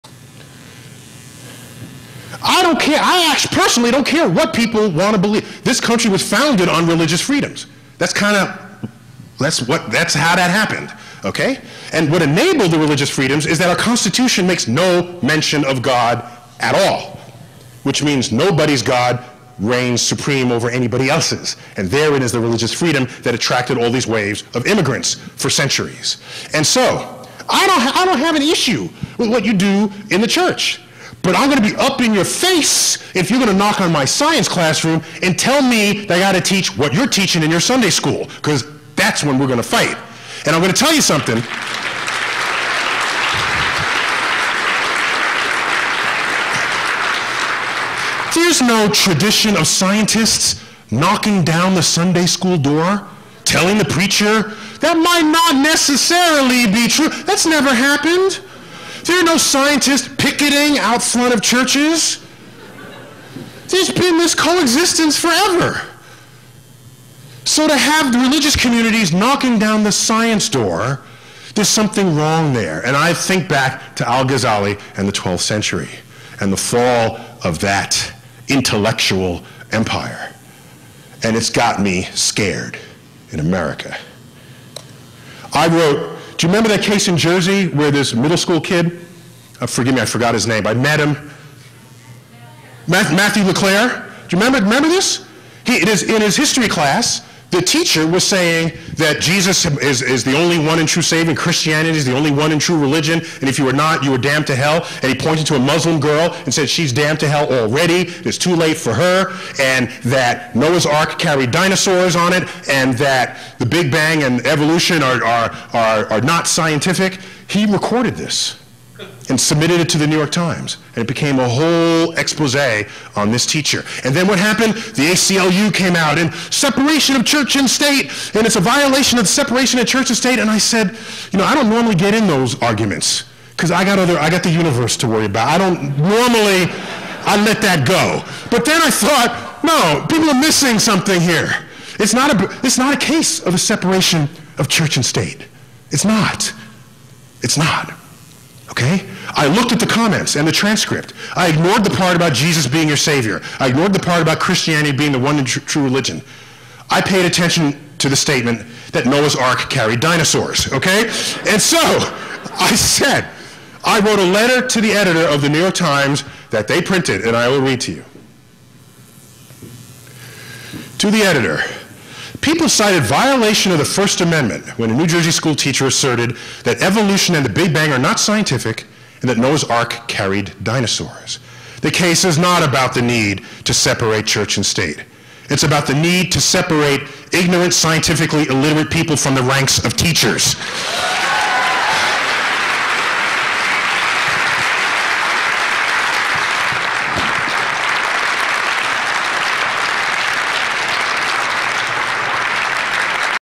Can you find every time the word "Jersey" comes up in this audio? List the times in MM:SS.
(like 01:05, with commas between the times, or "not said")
01:27, 02:55.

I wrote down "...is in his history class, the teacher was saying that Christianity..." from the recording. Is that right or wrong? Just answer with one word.
wrong.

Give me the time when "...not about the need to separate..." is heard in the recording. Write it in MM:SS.
03:02.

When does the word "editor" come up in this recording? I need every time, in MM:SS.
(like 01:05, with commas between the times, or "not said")
02:44, 02:51.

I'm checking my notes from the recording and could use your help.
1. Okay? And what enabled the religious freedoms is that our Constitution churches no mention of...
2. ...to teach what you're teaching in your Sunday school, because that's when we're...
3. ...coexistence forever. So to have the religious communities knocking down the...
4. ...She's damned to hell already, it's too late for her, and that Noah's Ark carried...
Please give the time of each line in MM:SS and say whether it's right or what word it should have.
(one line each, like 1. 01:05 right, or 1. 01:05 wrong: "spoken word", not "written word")
1. 00:11 wrong: "makes", not "churches"
2. 00:36 right
3. 01:04 right
4. 01:46 right.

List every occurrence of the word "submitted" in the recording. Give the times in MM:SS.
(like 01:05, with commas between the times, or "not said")
01:59.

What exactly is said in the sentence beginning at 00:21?
And therein is the religious freedom that attracted all these waves of immigrants for centuries.